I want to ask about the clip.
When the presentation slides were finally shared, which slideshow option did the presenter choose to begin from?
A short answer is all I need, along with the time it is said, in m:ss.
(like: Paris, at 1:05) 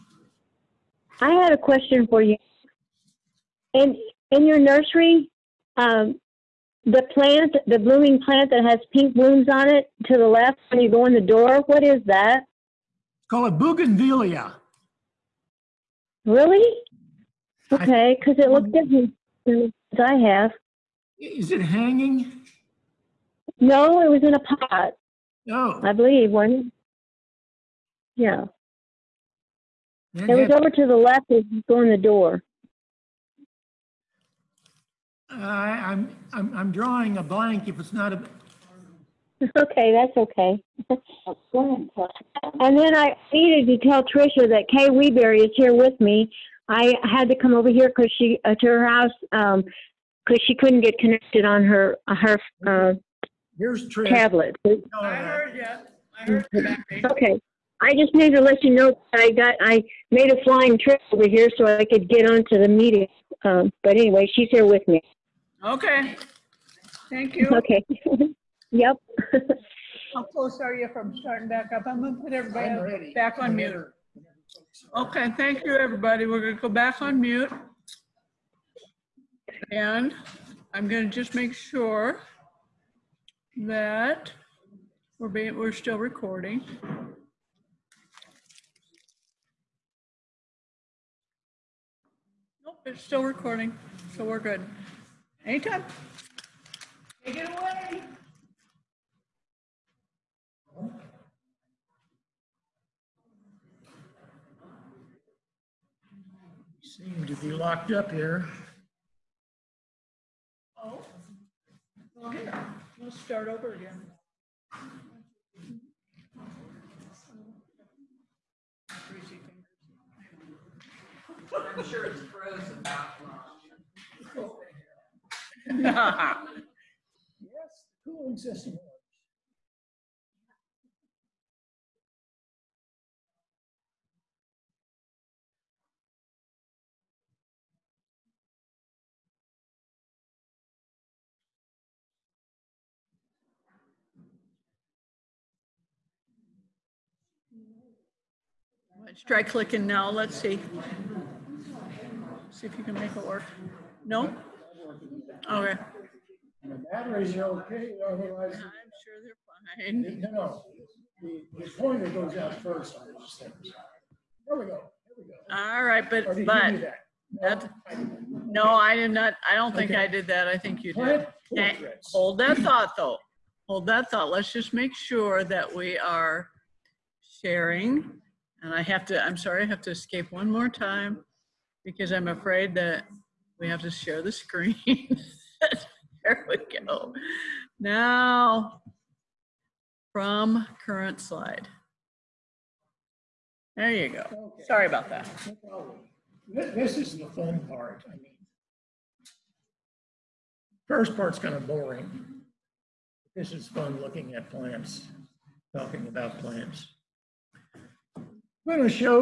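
From current slide, at 3:10.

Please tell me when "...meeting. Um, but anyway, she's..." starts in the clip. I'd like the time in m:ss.
1:02.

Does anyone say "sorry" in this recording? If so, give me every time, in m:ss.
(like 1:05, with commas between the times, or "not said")
2:59, 3:14.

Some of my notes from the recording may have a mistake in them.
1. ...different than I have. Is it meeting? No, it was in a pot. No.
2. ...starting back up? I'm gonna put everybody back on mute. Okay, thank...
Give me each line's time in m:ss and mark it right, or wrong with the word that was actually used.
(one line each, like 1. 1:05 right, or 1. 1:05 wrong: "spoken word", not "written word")
1. 0:18 wrong: "hanging", not "meeting"
2. 1:11 right.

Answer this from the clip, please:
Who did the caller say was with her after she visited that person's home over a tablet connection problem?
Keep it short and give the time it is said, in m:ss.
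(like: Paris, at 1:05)
Kay Weberry, at 0:44.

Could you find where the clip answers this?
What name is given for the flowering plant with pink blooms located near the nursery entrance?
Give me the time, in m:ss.
0:13.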